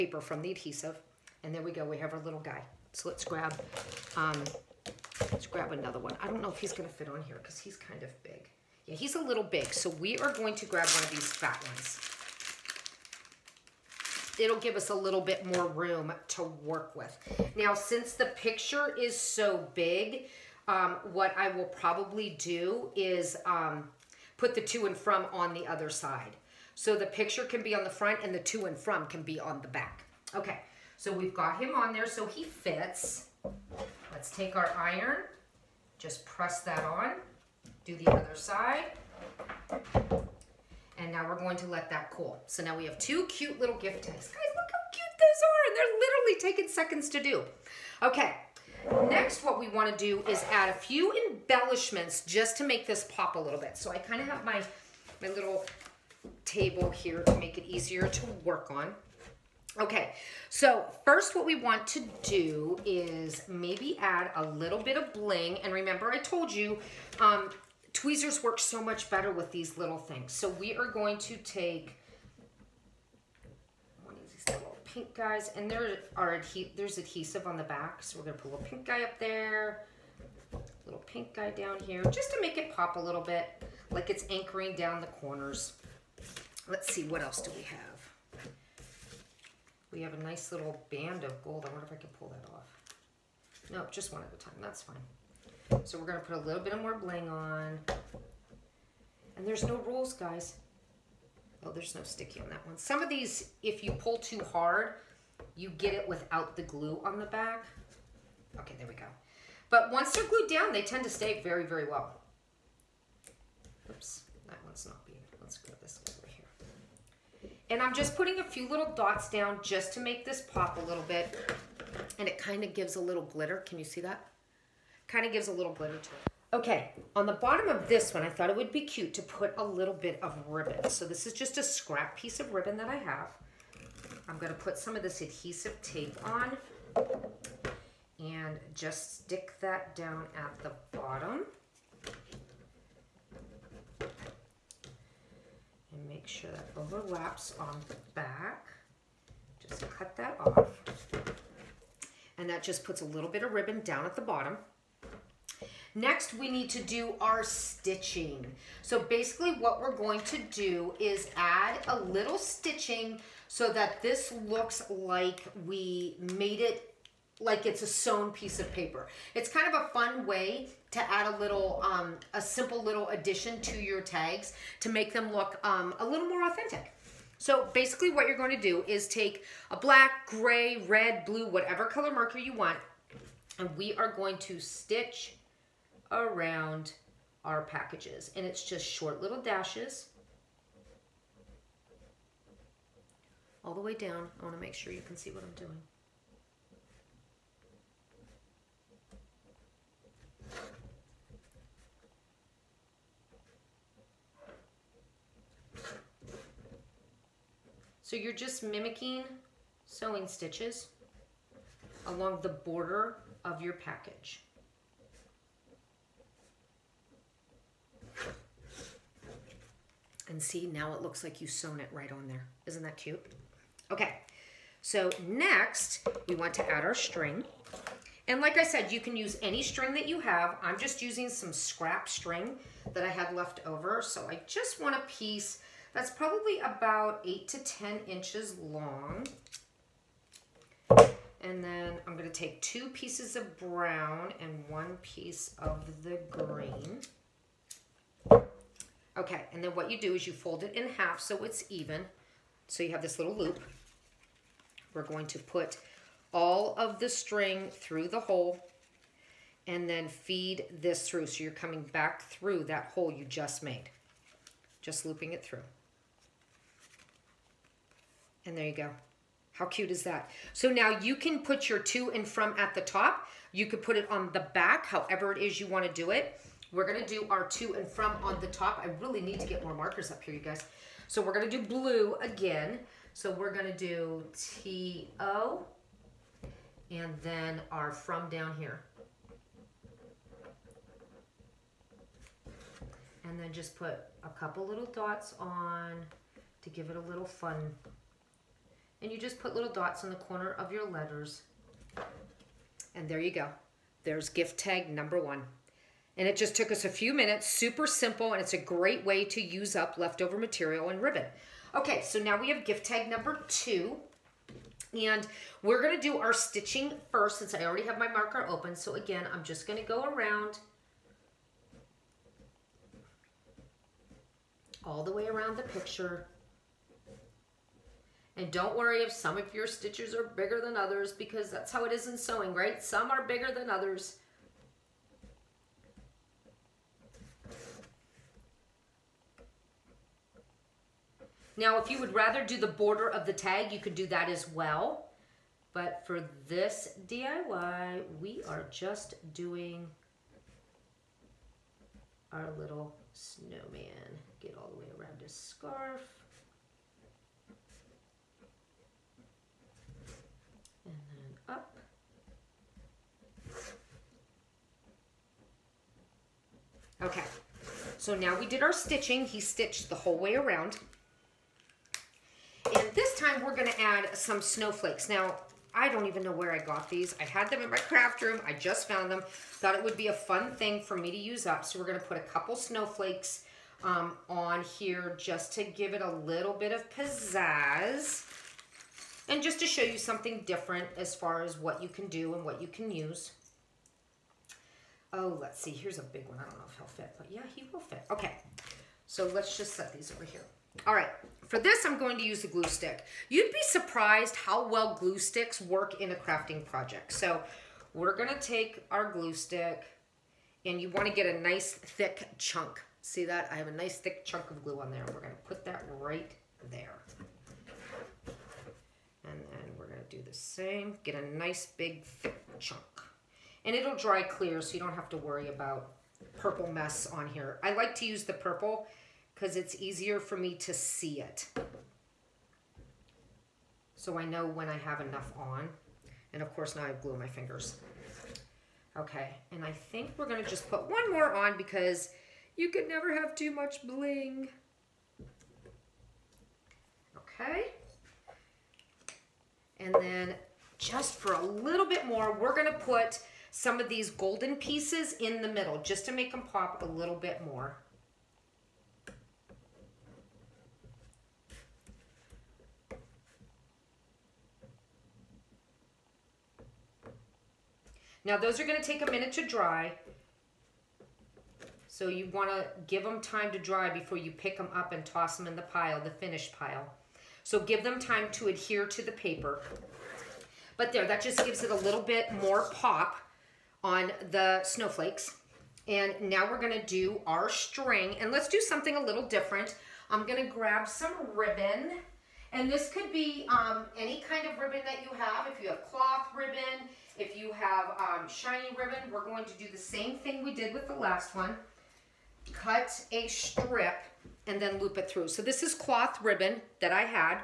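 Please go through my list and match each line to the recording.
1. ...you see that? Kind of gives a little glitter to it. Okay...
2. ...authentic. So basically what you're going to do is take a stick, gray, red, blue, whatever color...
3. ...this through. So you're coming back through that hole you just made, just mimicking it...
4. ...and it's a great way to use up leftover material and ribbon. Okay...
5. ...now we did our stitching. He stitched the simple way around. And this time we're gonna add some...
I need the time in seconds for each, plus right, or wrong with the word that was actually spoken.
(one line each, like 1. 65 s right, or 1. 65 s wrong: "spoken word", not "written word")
1. 123 s right
2. 176 s wrong: "black", not "stick"
3. 260 s wrong: "looping", not "mimicking"
4. 308 s right
5. 368 s wrong: "whole", not "simple".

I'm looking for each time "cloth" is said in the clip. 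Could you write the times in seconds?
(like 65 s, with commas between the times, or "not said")
495 s, 505 s.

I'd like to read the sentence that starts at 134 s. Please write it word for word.
I'm gonna put some of this adhesive tape on and just stick that down at the bottom.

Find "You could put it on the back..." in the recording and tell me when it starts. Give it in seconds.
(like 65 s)
273 s.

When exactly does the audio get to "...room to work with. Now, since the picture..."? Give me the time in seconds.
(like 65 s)
15 s.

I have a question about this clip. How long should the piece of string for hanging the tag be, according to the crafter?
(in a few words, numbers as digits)
8 to 10 inches.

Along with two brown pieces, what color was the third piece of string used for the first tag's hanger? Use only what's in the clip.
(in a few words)
Green.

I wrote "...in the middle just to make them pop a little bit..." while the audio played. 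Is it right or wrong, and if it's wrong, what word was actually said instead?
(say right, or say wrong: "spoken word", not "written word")
right.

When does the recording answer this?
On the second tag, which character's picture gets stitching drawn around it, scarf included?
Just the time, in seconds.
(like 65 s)
353 s.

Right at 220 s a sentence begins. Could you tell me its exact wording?
And see, now it looks like you sewn it right on there.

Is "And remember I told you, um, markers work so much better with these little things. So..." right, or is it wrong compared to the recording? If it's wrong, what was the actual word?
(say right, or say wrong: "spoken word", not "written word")
wrong: "tweezers", not "markers".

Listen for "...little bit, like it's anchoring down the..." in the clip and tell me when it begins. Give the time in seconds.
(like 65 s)
83 s.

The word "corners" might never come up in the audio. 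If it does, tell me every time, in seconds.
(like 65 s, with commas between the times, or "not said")
85 s, 300 s.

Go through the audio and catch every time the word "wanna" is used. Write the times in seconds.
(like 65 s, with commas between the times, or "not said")
194 s, 410 s, 472 s.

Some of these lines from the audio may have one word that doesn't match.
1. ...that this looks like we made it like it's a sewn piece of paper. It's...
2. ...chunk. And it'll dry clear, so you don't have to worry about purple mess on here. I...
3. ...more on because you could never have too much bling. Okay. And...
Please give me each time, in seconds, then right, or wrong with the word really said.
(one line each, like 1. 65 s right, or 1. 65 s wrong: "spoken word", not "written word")
1. 163 s right
2. 422 s right
3. 441 s right.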